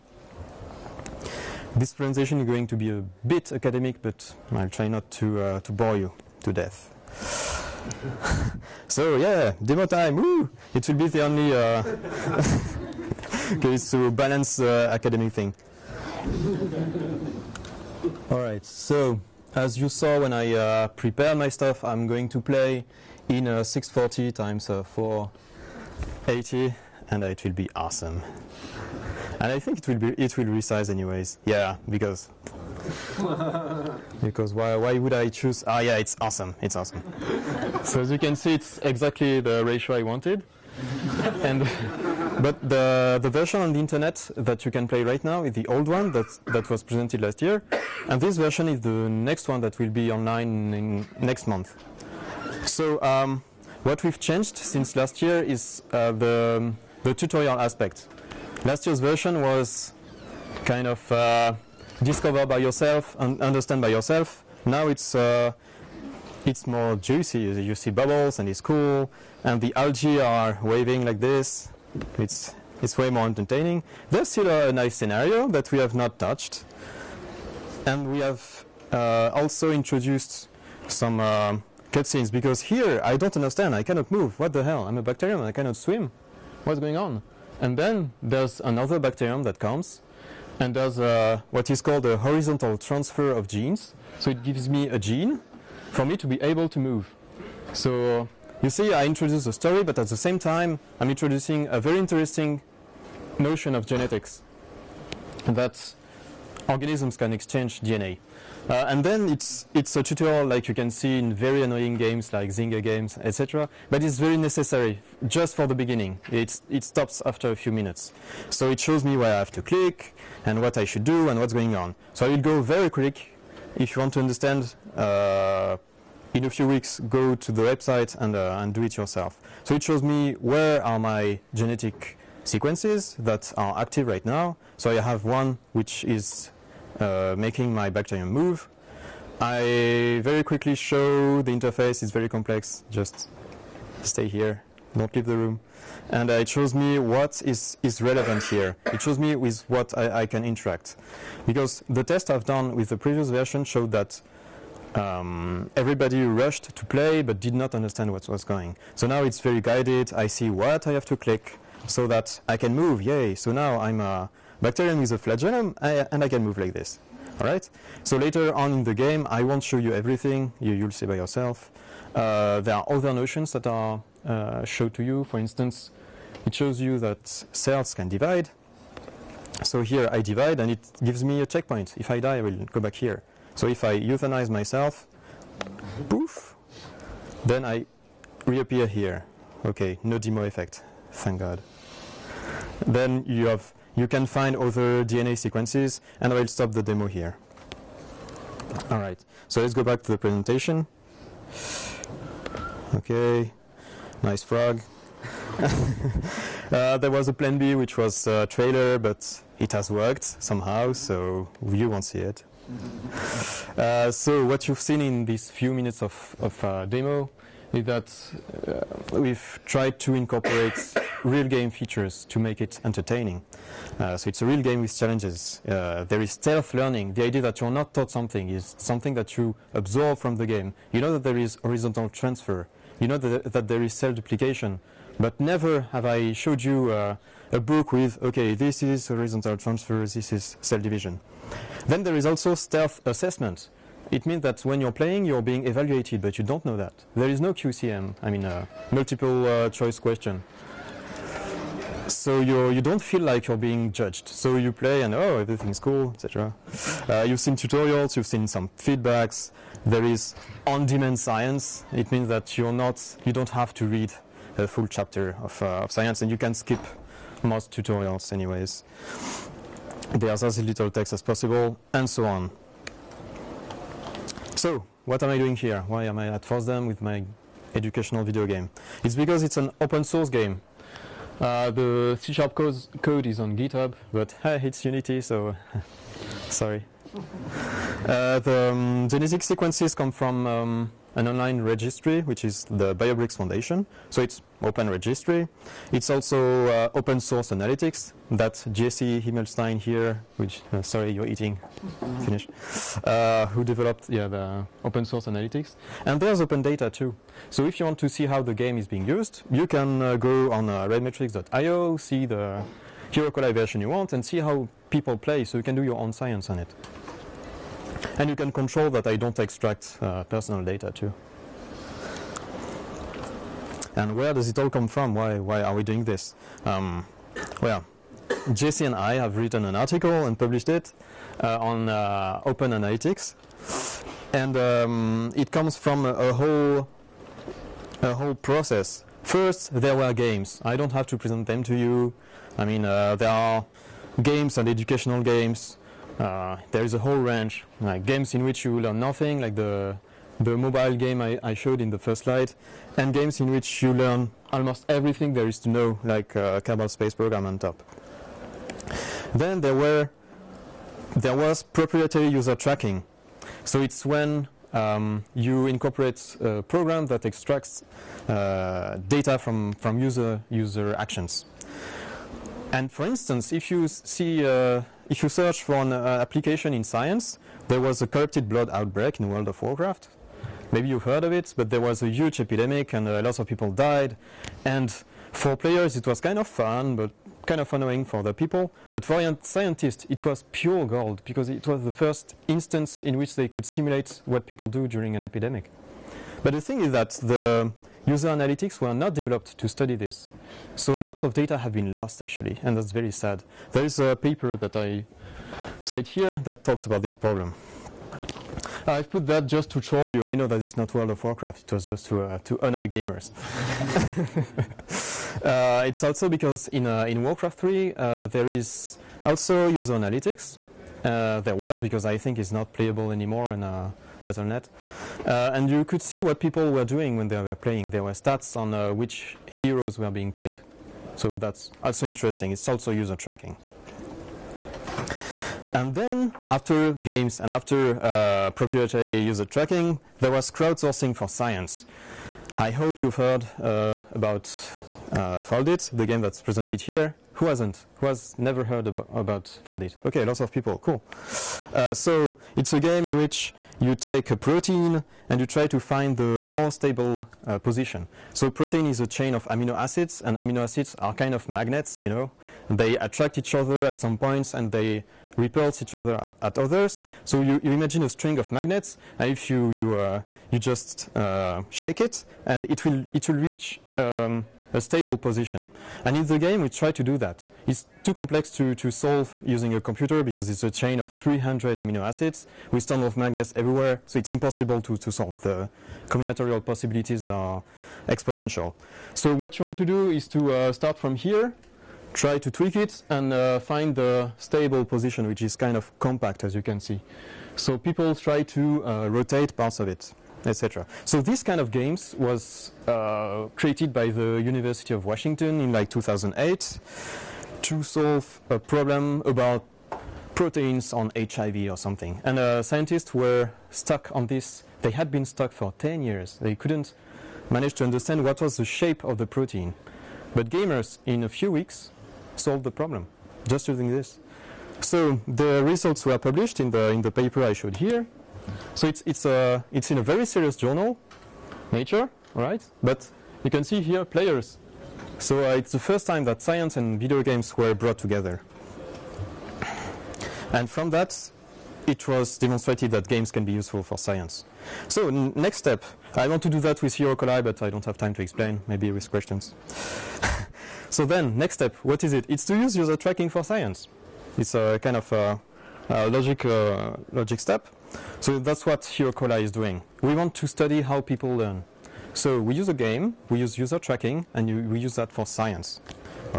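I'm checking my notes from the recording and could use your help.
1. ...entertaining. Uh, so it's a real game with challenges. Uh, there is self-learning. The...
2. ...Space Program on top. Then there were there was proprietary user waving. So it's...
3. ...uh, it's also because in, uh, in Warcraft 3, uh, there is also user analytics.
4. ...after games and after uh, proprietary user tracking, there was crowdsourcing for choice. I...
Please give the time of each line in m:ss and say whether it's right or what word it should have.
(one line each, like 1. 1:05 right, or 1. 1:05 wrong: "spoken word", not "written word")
1. 3:42 right
2. 5:56 wrong: "tracking", not "waving"
3. 6:55 right
4. 7:16 wrong: "science", not "choice".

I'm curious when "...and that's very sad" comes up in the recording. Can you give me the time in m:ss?
6:42.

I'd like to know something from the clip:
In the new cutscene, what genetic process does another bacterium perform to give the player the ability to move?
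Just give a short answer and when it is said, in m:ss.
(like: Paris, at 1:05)
horizontal transfer of genes, at 1:32.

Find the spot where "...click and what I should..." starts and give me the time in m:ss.
1:59.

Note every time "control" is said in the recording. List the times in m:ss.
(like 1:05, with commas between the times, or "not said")
5:18.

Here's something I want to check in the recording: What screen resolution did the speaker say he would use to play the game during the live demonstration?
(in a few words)
640 x 480.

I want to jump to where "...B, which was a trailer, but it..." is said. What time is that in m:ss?
3:27.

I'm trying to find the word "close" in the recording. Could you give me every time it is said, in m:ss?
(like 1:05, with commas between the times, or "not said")
not said.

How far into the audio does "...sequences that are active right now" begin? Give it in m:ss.
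2:12.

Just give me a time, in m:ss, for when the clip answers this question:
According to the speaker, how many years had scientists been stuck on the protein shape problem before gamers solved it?
8:35.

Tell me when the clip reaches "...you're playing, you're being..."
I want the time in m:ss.
4:04.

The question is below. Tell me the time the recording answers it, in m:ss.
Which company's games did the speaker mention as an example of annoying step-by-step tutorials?
1:52.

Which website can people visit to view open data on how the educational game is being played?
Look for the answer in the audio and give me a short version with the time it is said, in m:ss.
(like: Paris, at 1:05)
redmetrics.io, at 5:10.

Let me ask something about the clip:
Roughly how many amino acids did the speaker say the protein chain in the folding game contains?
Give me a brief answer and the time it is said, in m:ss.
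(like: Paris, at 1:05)
300, at 8:01.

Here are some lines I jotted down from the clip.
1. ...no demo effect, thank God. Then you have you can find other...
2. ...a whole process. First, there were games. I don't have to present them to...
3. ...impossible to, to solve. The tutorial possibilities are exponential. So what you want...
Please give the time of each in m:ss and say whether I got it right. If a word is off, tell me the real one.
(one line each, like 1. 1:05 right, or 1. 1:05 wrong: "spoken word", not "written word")
1. 3:10 right
2. 5:38 right
3. 8:04 wrong: "combinatorial", not "tutorial".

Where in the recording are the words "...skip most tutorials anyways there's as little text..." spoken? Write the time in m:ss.
4:26.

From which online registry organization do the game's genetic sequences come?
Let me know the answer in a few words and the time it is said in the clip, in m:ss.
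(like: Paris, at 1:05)
BioBricks Foundation, at 4:52.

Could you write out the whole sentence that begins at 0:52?
So um, what we've changed since last year is uh, the, the tutorial aspect.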